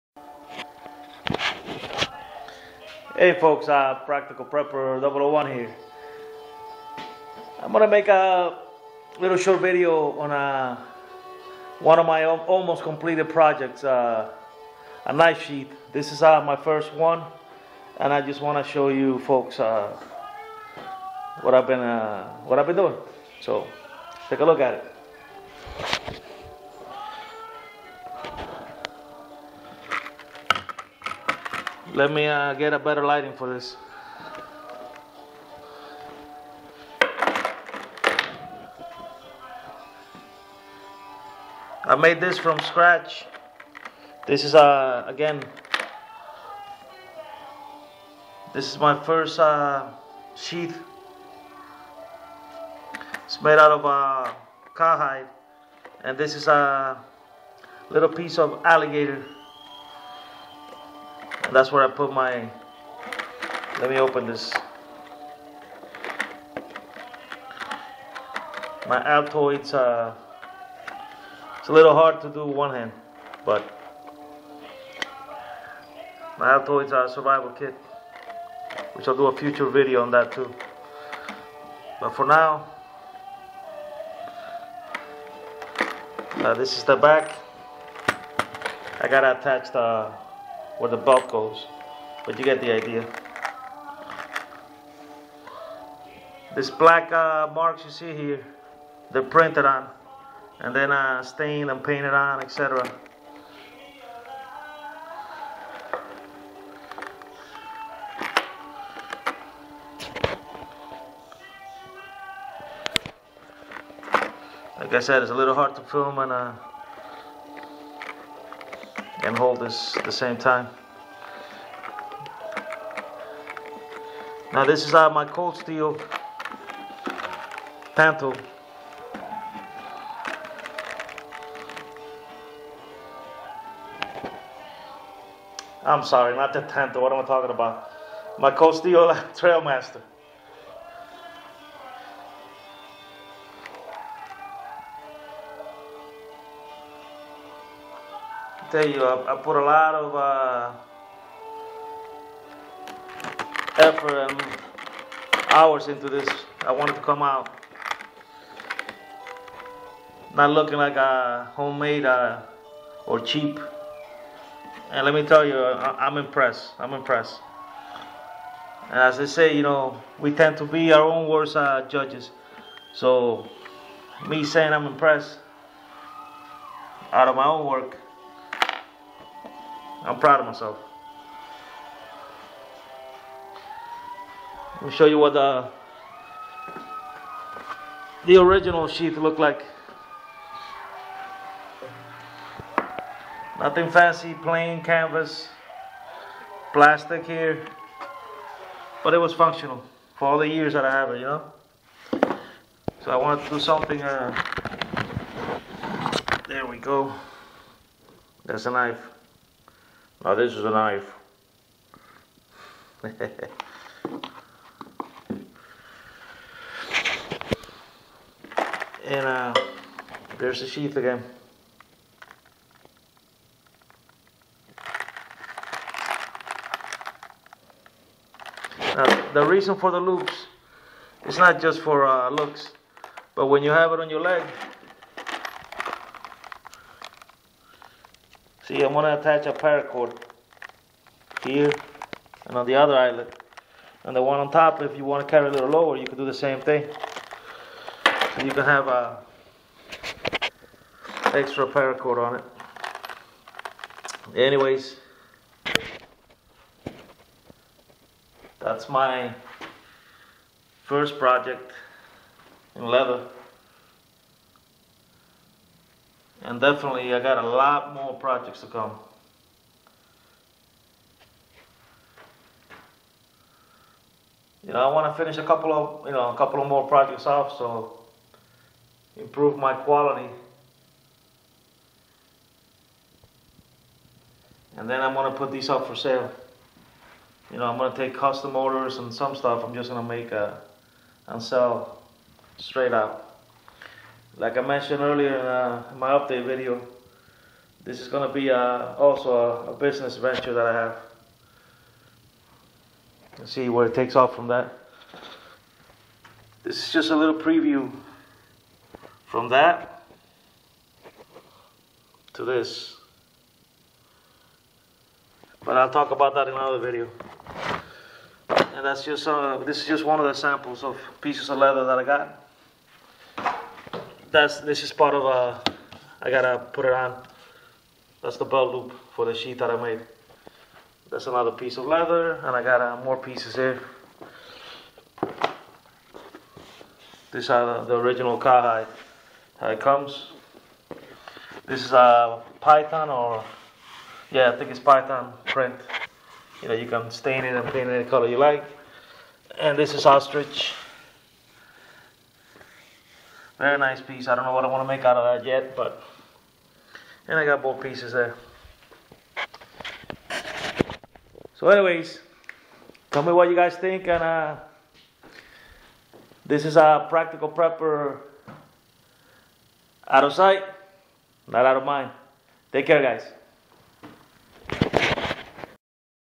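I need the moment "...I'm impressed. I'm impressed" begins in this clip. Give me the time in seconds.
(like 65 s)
166 s.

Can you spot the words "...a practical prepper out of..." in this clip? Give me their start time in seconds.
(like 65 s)
366 s.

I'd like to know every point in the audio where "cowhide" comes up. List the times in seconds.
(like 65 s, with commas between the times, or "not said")
54 s, 338 s.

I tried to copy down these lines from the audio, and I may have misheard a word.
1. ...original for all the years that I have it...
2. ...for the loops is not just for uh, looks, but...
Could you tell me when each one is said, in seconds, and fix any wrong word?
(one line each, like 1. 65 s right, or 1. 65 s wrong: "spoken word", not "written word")
1. 199 s wrong: "functional", not "original"
2. 229 s right.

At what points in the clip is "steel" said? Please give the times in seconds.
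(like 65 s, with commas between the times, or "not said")
125 s, 138 s.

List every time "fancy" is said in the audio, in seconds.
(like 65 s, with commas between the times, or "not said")
193 s.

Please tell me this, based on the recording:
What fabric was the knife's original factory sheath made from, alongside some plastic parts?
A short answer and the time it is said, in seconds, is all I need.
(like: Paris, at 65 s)
Canvas, at 194 s.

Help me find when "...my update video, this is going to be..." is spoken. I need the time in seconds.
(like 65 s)
295 s.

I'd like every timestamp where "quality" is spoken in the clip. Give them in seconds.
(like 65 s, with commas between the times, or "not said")
279 s.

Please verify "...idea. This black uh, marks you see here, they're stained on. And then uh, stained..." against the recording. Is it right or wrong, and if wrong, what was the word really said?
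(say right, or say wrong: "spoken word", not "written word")
wrong: "printed", not "stained".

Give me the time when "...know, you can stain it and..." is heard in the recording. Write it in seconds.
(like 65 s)
346 s.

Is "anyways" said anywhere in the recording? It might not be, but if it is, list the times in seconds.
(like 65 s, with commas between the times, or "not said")
254 s, 361 s.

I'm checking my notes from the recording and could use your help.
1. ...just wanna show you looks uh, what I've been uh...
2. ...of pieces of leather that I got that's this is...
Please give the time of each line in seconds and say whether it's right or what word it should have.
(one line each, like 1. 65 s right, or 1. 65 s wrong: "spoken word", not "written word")
1. 18 s wrong: "folks", not "looks"
2. 320 s right.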